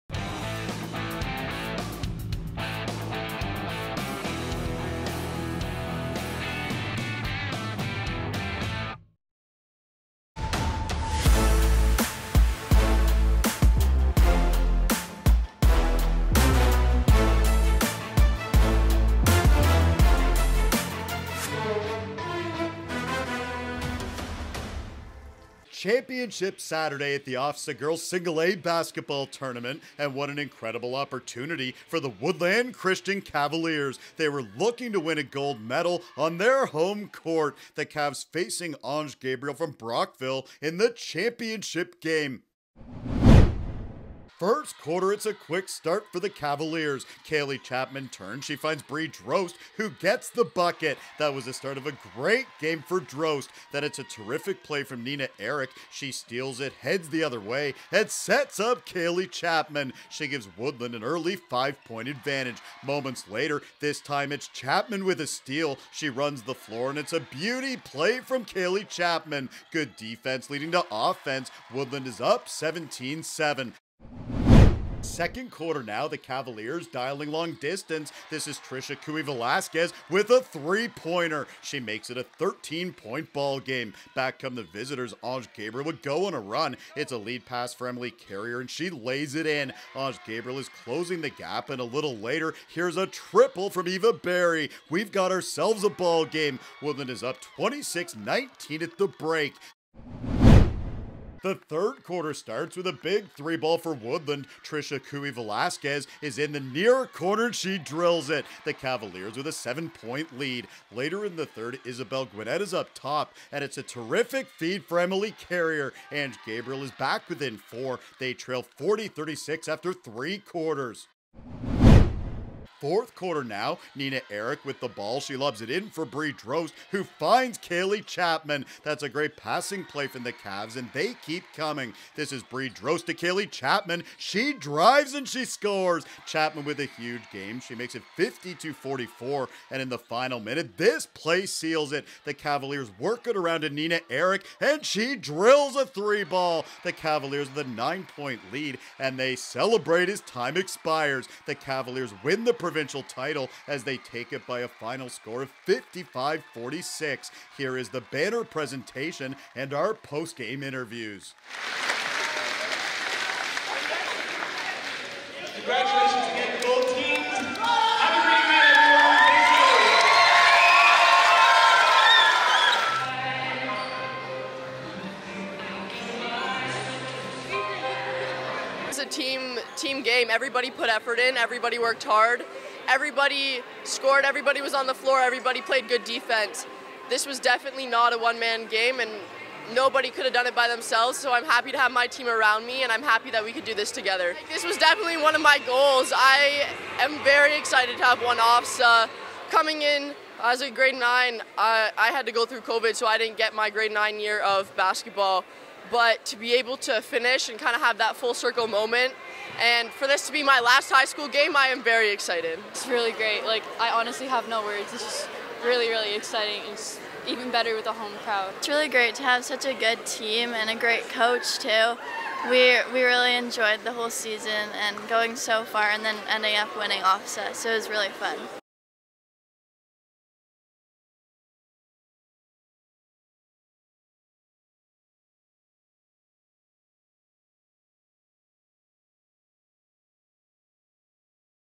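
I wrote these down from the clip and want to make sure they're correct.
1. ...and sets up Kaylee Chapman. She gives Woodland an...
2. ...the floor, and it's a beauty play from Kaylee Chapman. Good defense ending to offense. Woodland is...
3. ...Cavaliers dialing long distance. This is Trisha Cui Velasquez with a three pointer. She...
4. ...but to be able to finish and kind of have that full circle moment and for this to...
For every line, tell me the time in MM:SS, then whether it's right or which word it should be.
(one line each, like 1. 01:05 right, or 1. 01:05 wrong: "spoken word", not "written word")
1. 00:57 right
2. 01:06 wrong: "leading", not "ending"
3. 01:16 right
4. 03:25 right.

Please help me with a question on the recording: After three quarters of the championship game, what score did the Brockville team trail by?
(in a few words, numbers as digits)
40-36.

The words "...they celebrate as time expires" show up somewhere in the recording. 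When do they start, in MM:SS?
02:29.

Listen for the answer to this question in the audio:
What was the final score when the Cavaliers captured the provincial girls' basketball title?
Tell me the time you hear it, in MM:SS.
02:35.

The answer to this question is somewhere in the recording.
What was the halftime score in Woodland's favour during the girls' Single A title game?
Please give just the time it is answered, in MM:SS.
01:37.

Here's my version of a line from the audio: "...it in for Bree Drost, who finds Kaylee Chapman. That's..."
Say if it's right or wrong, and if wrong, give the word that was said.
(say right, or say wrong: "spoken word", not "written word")
right.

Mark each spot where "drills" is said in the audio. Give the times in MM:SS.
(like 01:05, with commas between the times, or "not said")
01:47, 02:25.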